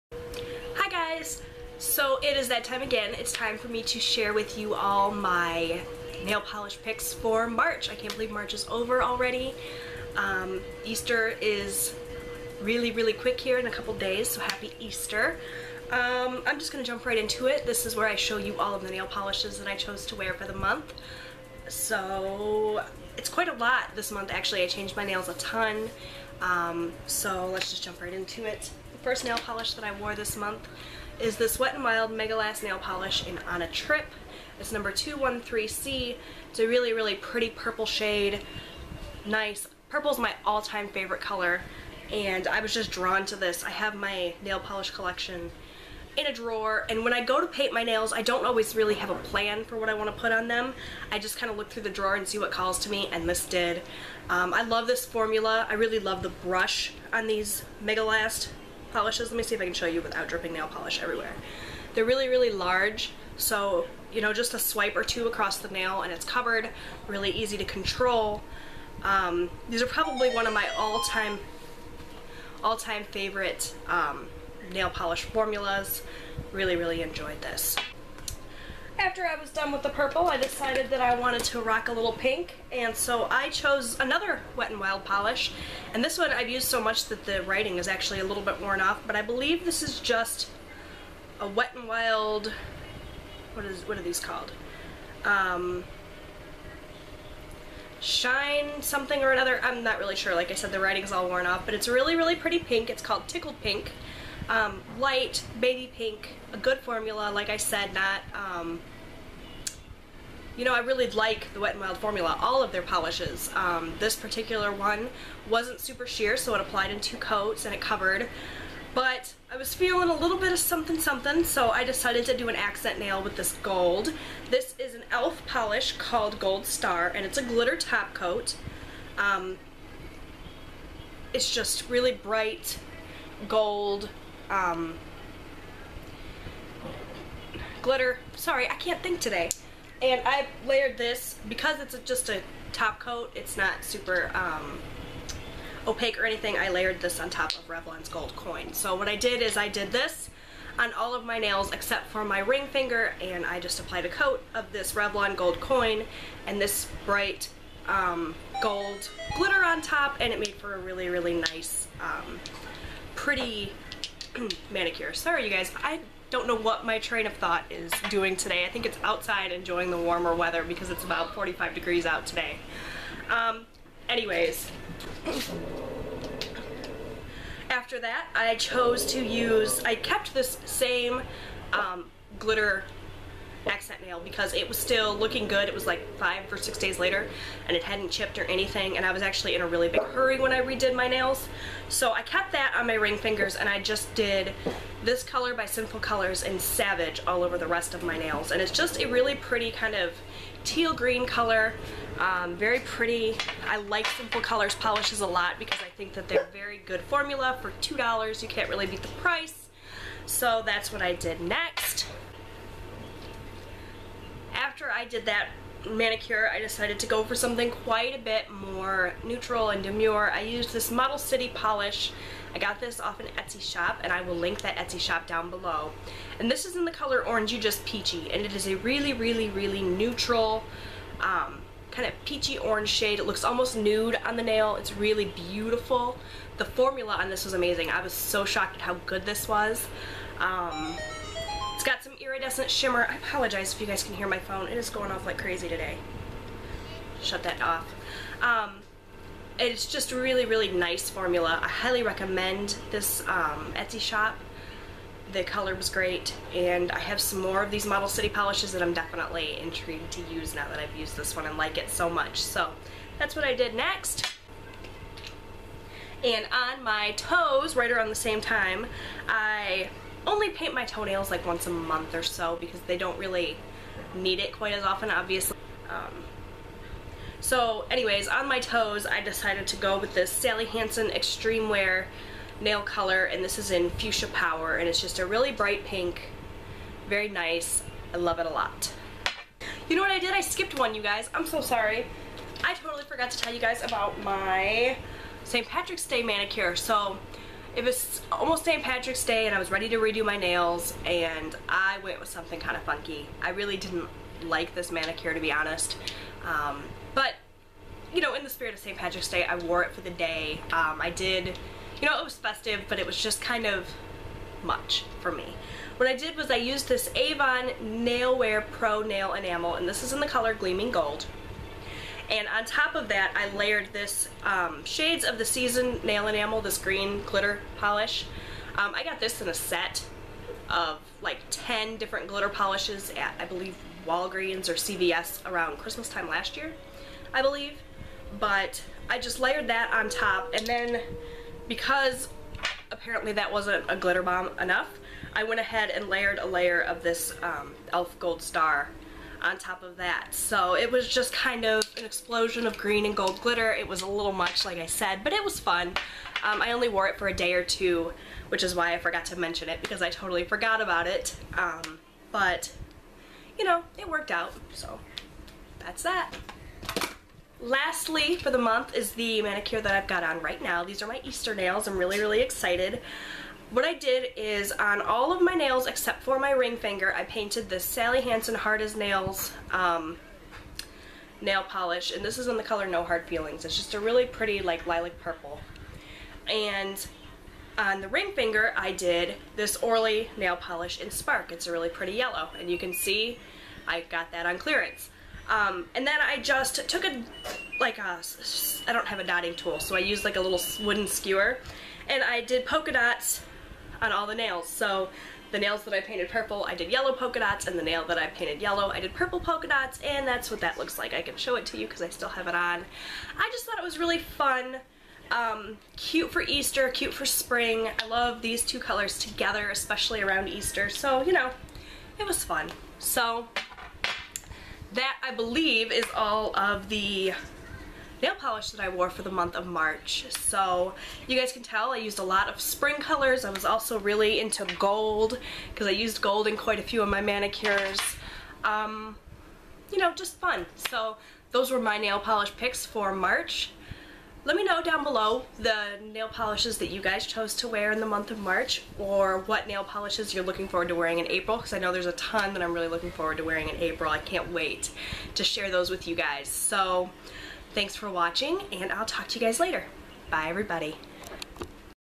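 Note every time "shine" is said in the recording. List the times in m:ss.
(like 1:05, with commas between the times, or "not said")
1:38.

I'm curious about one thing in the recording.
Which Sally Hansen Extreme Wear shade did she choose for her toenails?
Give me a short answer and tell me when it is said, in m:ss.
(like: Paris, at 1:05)
Fuchsia Power, at 4:43.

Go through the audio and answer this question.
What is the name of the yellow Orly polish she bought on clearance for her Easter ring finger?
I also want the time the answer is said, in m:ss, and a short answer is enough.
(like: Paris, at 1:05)
Spark, at 6:31.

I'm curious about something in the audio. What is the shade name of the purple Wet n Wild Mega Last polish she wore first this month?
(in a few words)
On a Trip.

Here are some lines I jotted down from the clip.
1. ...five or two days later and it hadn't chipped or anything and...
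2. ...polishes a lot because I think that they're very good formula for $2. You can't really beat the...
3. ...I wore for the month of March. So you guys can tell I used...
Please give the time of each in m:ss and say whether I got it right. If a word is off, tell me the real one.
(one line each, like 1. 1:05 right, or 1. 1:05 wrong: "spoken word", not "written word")
1. 3:06 wrong: "six", not "two"
2. 3:24 right
3. 7:08 right.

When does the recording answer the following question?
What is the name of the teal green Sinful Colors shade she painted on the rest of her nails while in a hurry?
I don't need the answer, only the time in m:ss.
3:16.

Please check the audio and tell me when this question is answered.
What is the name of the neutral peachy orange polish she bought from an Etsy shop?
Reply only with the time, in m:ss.
3:47.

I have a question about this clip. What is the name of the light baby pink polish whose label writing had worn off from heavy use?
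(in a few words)
Tickled Pink.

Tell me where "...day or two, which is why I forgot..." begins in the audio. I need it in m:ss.
5:57.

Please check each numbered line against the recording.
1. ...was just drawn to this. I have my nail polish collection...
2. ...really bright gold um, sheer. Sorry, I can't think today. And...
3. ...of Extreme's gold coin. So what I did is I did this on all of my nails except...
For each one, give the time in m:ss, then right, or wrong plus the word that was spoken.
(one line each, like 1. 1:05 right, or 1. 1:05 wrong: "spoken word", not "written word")
1. 0:42 right
2. 2:11 wrong: "glitter", not "sheer"
3. 2:27 wrong: "Revlon", not "Extreme".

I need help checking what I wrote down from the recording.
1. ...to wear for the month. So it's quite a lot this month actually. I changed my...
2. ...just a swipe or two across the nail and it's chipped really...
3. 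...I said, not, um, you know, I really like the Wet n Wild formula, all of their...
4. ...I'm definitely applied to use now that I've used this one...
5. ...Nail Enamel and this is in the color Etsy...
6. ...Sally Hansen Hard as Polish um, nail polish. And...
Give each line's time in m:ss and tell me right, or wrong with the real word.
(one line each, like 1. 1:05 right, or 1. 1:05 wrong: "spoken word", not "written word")
1. 0:20 right
2. 1:04 wrong: "covered", not "chipped"
3. 1:47 right
4. 4:18 wrong: "intrigued", not "applied"
5. 5:19 wrong: "Gleaming", not "Etsy"
6. 6:17 wrong: "Nails", not "Polish".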